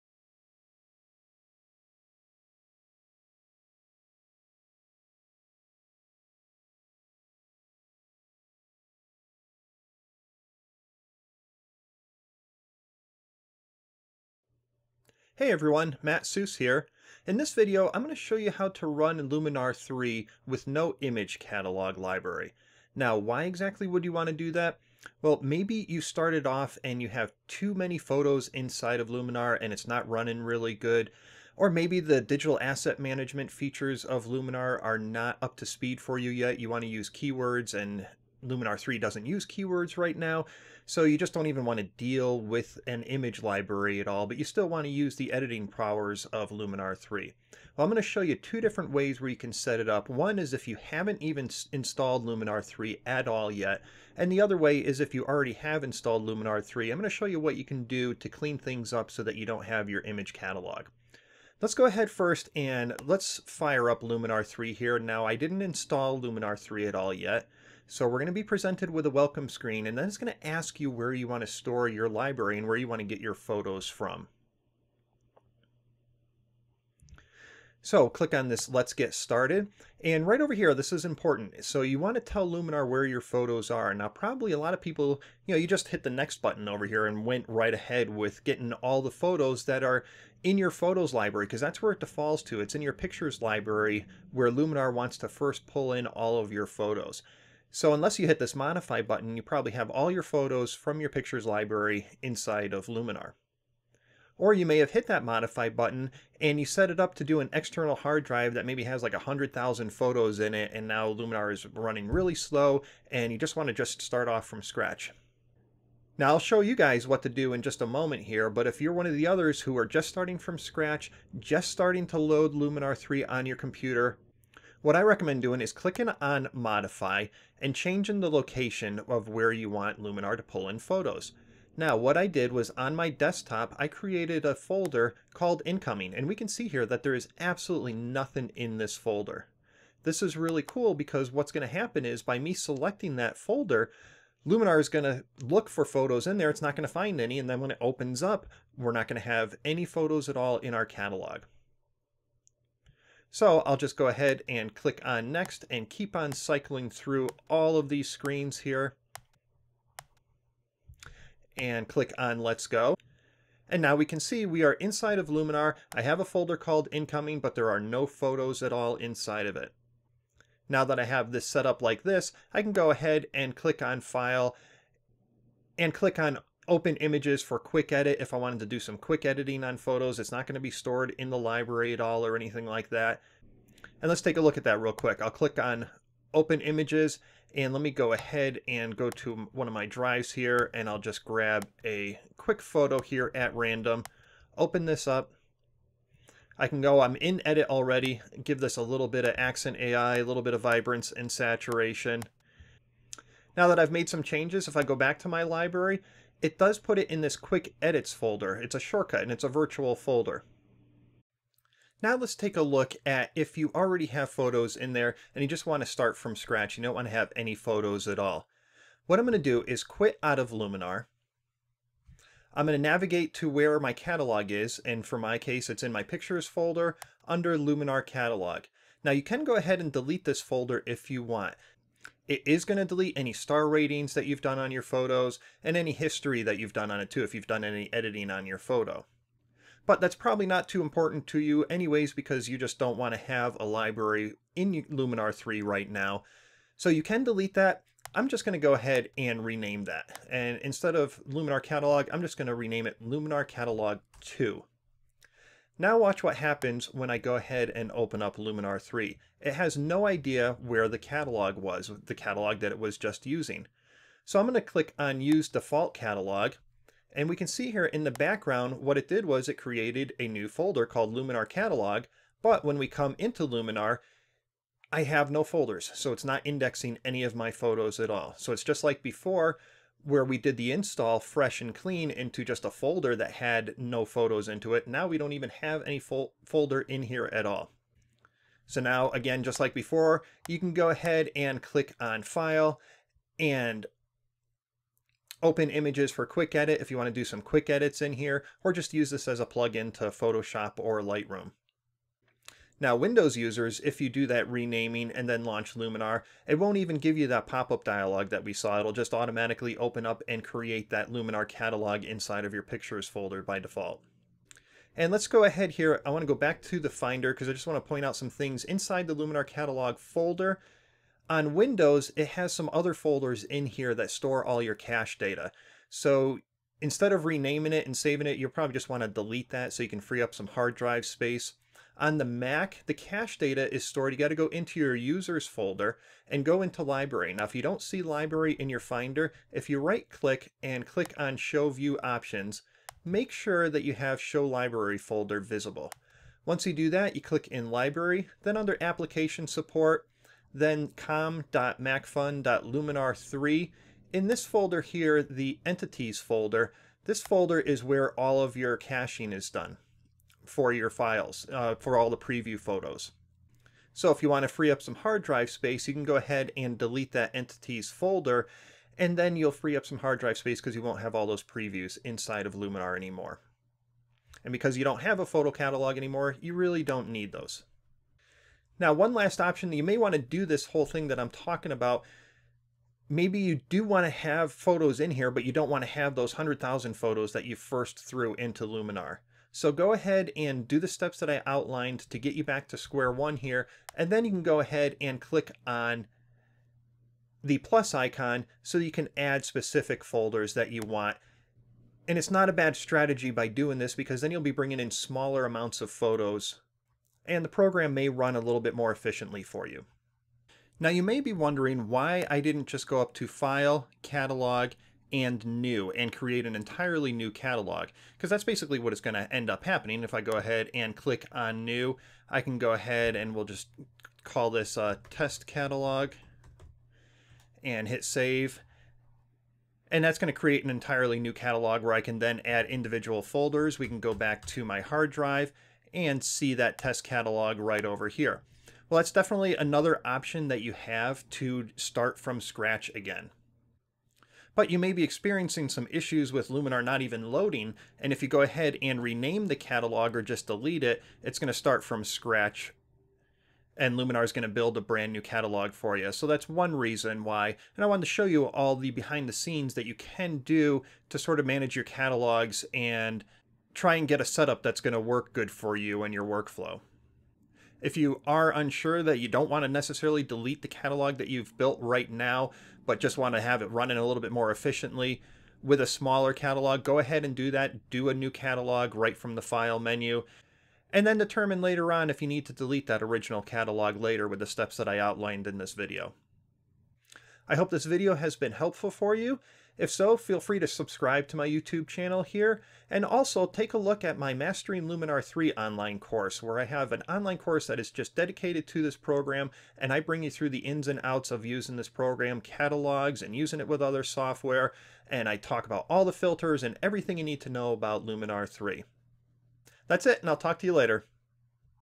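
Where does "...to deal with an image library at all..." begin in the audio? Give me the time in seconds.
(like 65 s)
41 s.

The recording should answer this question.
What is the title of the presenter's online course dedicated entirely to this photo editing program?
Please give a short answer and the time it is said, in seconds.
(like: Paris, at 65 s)
Mastering Luminar 3, at 494 s.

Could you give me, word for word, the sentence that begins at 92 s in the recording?
It's in your pictures library where Luminar wants to first pull in all of your photos.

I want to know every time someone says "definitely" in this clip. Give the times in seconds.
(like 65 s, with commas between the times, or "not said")
439 s.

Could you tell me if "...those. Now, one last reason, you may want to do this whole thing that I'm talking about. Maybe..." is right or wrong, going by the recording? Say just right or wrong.
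wrong.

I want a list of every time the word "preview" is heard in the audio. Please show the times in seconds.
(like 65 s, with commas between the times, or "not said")
362 s, 371 s.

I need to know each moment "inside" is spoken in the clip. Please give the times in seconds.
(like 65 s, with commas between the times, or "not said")
28 s, 102 s, 164 s, 168 s, 312 s, 318 s, 372 s.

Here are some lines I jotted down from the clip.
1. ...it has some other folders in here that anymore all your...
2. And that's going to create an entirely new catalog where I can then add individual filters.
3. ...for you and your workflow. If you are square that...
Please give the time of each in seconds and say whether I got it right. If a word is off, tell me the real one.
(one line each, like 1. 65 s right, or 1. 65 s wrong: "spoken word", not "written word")
1. 322 s wrong: "store", not "anymore"
2. 429 s wrong: "folders", not "filters"
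3. 465 s wrong: "unsure", not "square".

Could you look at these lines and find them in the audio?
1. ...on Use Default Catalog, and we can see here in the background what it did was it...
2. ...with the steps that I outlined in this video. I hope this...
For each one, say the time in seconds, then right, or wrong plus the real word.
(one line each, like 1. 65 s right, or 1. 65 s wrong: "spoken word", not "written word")
1. 264 s right
2. 484 s right.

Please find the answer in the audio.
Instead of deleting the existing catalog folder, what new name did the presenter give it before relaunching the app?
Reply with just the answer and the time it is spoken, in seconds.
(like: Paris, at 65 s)
Luminar Catalog 2, at 253 s.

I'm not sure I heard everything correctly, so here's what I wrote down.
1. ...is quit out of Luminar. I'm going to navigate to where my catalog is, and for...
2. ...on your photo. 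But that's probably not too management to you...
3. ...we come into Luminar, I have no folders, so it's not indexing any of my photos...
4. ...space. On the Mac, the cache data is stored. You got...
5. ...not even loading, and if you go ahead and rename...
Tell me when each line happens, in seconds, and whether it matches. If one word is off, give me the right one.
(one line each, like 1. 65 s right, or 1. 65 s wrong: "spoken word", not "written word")
1. 219 s right
2. 238 s wrong: "important", not "management"
3. 272 s right
4. 331 s right
5. 446 s right.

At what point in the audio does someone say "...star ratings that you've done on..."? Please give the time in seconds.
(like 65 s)
233 s.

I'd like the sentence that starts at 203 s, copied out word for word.
Now that I've made some changes, if I go back to my library, it does put it in this quick edits folder.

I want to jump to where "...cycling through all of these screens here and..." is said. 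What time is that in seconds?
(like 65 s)
156 s.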